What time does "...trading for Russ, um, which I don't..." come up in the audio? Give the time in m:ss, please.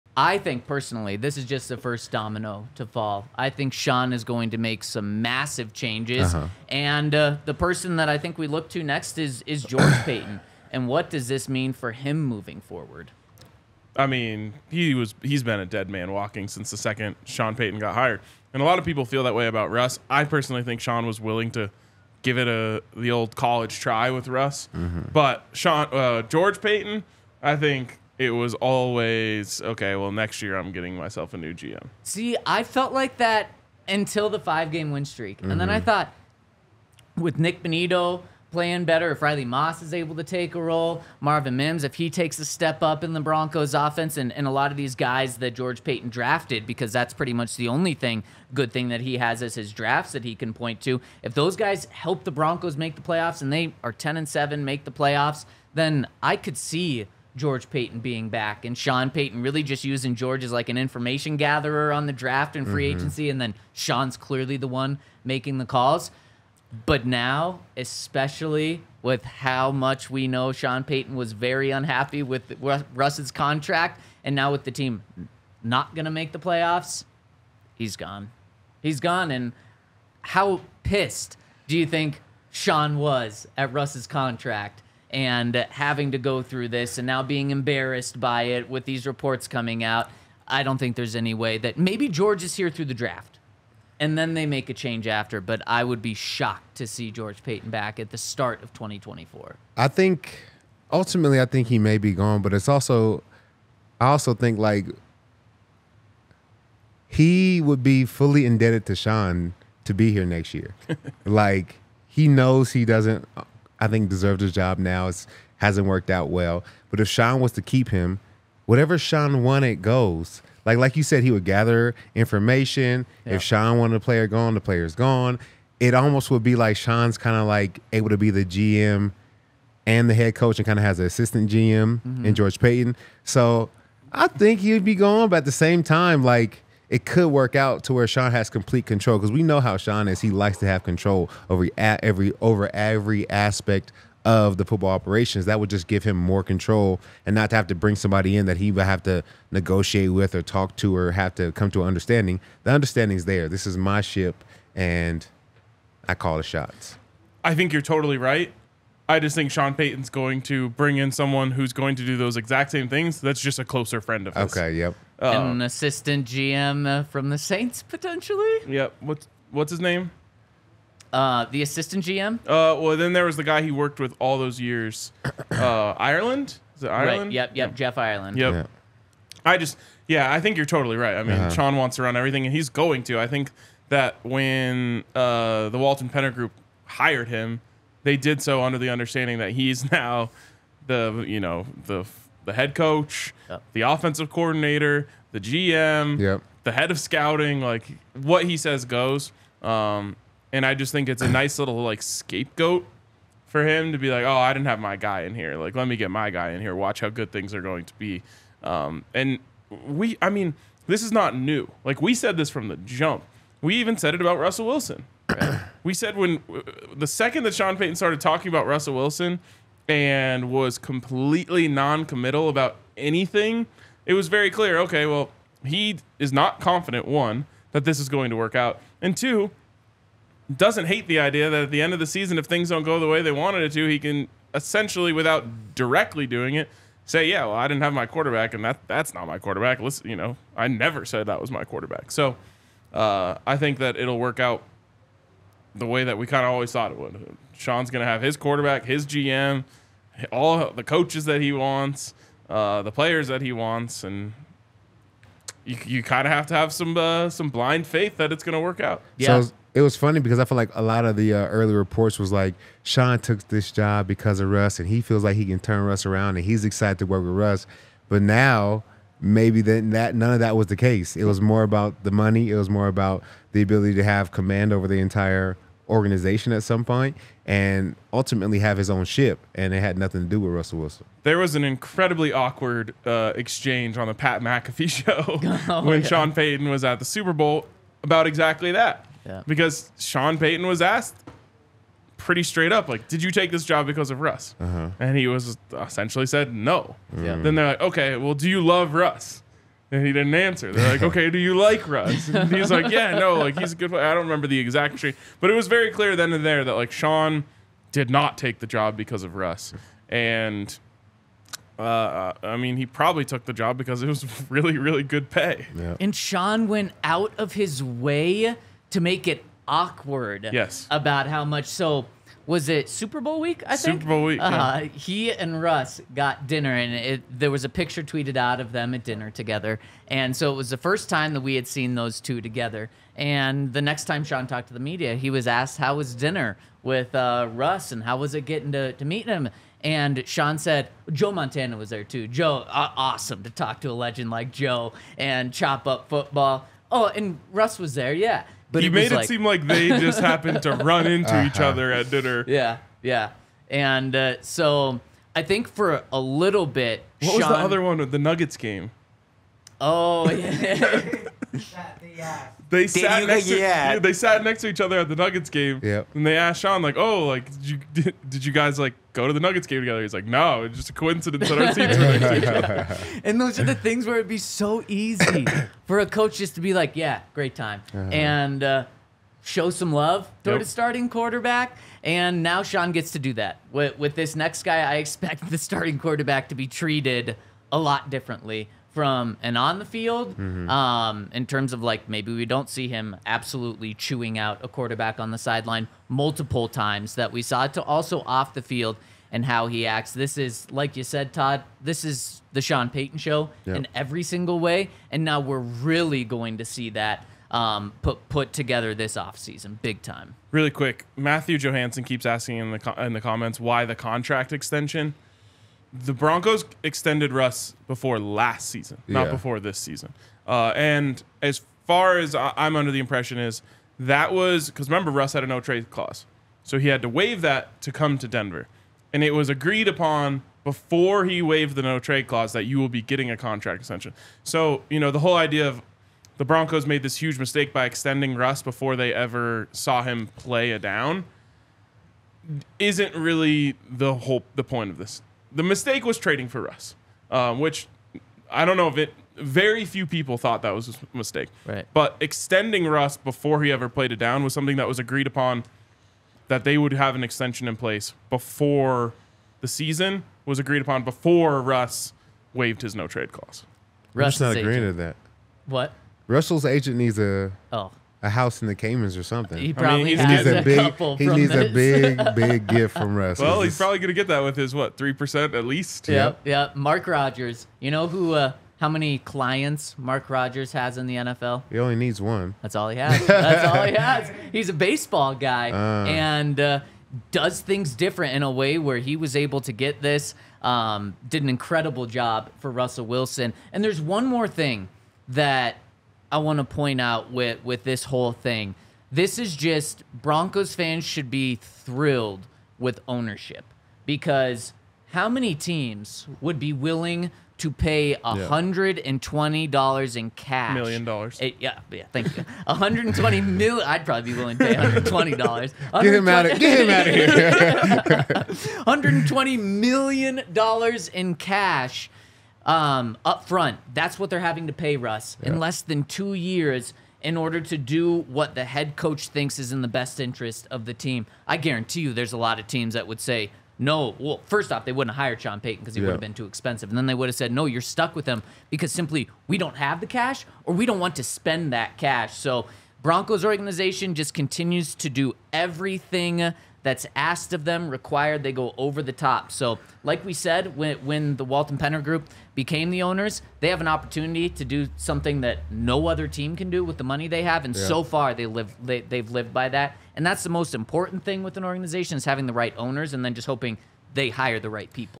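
7:26.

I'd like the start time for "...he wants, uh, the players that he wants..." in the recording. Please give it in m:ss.
4:11.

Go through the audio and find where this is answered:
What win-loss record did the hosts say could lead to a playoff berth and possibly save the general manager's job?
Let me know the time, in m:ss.
0:53.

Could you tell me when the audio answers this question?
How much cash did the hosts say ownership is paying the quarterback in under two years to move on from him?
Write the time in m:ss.
8:32.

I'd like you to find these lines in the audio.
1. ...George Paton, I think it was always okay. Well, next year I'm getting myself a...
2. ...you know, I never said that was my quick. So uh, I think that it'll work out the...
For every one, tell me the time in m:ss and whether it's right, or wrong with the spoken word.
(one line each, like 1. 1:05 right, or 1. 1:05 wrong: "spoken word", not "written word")
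1. 0:26 right
2. 4:00 wrong: "quarterback", not "quick".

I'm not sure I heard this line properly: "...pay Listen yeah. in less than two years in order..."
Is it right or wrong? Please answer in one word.
wrong.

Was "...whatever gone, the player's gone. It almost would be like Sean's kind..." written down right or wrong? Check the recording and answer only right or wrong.
wrong.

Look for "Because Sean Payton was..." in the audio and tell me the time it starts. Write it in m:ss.
4:49.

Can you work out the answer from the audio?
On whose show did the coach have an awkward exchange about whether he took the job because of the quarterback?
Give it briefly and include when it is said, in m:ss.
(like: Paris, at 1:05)
Pat McAfee, at 4:44.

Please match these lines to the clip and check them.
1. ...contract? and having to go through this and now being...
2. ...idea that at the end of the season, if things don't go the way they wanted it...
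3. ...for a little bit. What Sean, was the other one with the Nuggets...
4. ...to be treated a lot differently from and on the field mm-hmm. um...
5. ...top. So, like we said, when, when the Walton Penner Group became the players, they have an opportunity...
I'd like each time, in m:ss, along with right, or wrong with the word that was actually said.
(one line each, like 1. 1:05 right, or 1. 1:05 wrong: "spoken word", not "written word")
1. 1:24 right
2. 3:51 right
3. 5:55 right
4. 6:26 right
5. 9:09 wrong: "owners", not "players".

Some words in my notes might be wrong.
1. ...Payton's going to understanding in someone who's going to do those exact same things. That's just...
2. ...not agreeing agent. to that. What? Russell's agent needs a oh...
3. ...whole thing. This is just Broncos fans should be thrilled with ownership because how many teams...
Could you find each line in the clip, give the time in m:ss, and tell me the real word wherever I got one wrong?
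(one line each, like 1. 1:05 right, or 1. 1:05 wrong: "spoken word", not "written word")
1. 2:39 wrong: "bring", not "understanding"
2. 7:44 right
3. 8:18 right.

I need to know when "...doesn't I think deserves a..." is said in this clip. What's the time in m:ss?
1:52.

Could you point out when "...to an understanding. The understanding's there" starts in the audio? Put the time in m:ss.
2:31.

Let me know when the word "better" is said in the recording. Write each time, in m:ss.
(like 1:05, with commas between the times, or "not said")
0:38.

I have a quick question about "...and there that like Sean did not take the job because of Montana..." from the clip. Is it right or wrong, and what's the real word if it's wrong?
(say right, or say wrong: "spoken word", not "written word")
wrong: "Russ", not "Montana".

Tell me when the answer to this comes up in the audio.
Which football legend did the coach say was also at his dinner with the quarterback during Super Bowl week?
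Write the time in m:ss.
5:41.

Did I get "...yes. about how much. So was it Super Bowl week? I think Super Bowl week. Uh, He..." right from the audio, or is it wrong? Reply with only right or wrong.
right.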